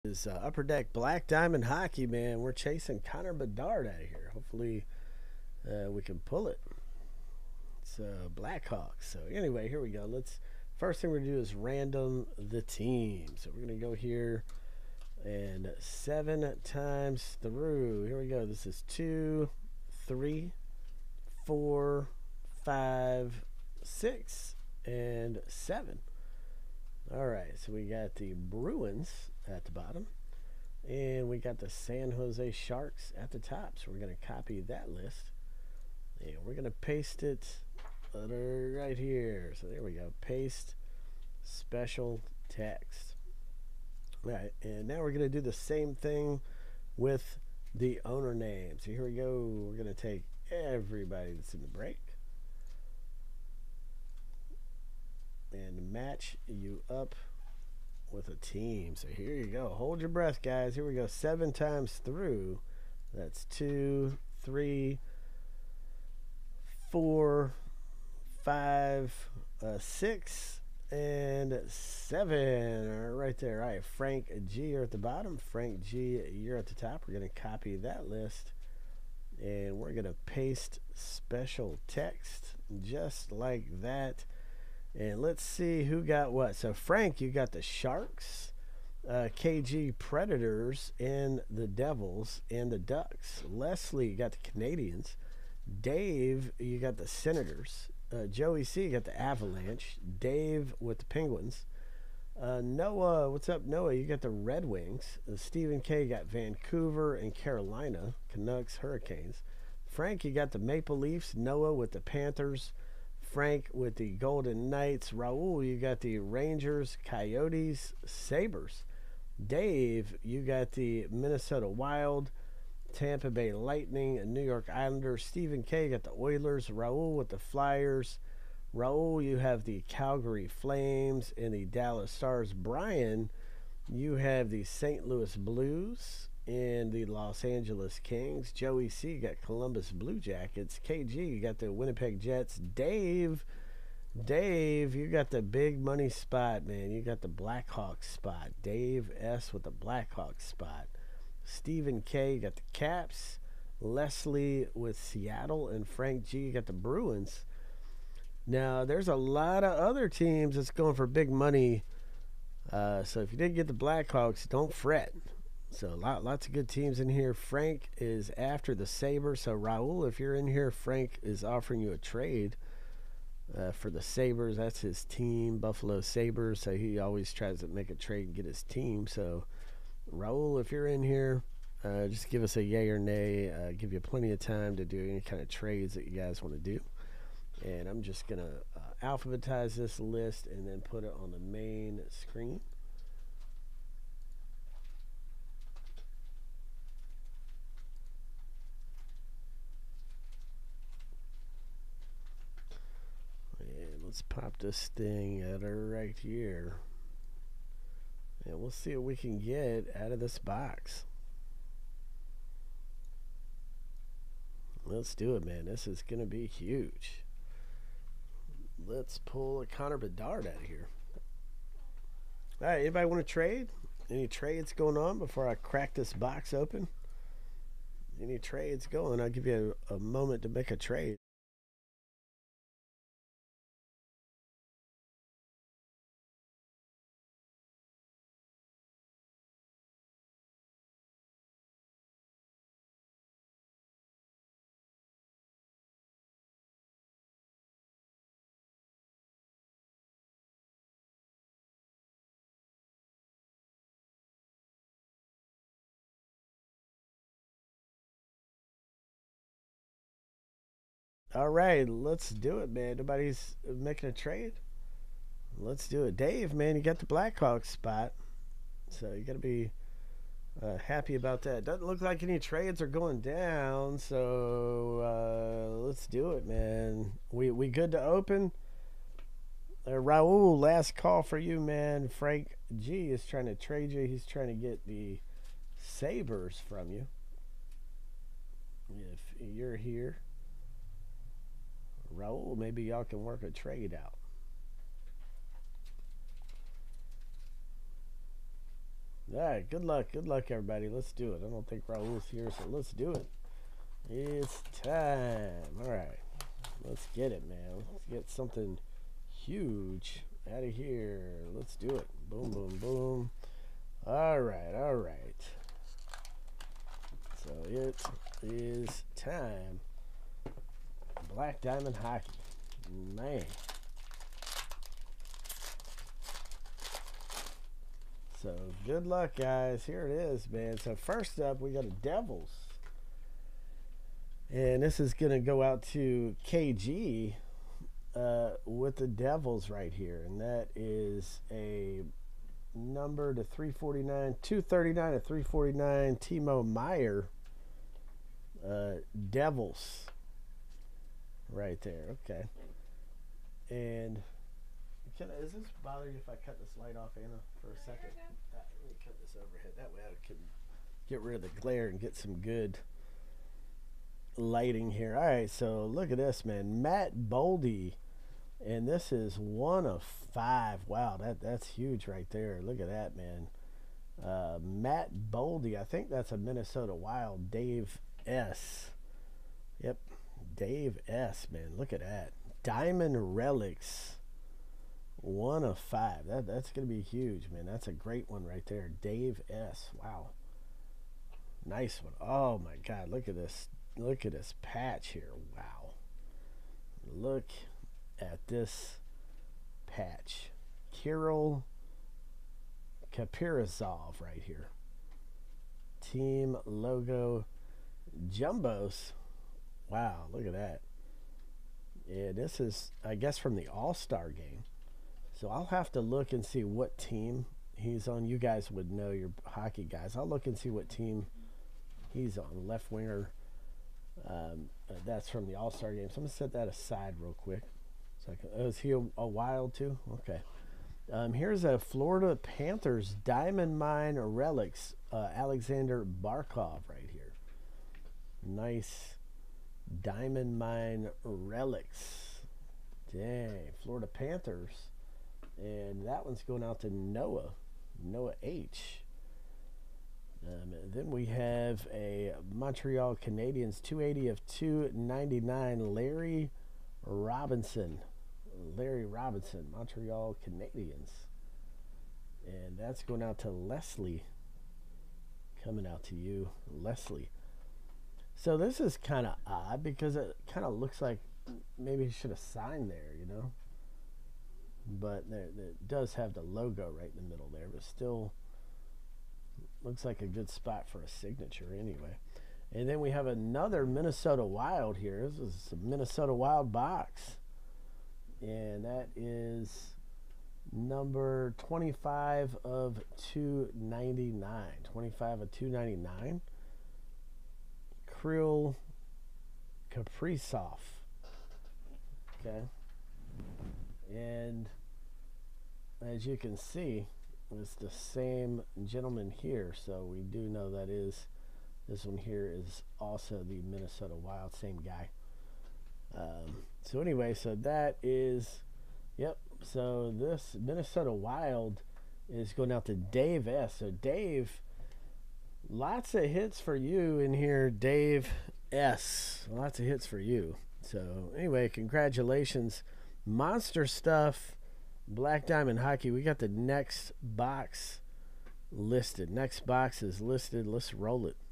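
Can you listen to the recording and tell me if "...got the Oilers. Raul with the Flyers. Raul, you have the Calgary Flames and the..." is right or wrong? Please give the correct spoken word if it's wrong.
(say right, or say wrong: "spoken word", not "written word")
right.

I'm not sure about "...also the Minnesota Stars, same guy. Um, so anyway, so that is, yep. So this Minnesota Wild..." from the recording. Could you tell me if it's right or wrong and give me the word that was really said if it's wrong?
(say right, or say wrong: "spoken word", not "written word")
wrong: "Wild", not "Stars".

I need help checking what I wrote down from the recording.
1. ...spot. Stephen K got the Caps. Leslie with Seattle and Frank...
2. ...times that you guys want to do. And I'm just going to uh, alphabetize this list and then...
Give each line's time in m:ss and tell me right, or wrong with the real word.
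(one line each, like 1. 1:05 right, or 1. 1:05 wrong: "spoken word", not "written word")
1. 2:30 right
2. 3:05 wrong: "trades", not "times".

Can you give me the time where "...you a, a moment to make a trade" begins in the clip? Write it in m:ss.
3:49.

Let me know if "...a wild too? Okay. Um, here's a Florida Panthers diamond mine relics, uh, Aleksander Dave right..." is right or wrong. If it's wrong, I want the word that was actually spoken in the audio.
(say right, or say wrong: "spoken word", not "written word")
wrong: "Barkov", not "Dave".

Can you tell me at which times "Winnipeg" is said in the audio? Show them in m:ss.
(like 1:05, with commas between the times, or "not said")
2:21.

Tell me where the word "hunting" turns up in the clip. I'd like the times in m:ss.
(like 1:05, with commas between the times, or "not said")
not said.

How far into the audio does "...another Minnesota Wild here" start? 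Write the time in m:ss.
8:03.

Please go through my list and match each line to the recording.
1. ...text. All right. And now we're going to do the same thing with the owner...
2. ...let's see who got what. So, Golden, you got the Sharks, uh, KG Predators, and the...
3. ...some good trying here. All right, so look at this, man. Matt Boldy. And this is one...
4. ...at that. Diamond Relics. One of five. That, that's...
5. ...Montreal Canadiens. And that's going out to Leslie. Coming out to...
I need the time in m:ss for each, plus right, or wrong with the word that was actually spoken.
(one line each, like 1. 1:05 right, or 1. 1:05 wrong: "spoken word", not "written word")
1. 0:42 right
2. 1:25 wrong: "Frank", not "Golden"
3. 6:02 wrong: "lighting", not "trying"
4. 6:21 right
5. 7:39 right.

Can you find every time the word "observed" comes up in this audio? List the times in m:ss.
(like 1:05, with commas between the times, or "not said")
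not said.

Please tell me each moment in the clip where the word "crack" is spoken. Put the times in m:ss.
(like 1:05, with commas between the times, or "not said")
3:45.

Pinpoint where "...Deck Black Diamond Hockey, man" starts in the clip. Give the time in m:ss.
0:00.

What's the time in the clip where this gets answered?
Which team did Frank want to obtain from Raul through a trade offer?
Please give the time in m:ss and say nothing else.
2:55.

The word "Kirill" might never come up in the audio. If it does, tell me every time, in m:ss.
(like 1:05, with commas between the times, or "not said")
6:40, 8:18.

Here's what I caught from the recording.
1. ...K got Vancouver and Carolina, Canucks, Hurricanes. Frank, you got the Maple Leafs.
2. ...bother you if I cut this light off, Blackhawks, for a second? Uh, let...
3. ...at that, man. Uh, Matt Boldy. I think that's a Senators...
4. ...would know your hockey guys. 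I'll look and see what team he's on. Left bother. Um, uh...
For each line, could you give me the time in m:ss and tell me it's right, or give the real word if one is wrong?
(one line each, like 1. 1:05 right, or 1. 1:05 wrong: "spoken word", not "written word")
1. 1:45 right
2. 5:55 wrong: "Anna", not "Blackhawks"
3. 6:12 wrong: "Minnesota", not "Senators"
4. 6:58 wrong: "winger", not "bother".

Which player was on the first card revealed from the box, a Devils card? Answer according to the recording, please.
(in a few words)
Timo Meier.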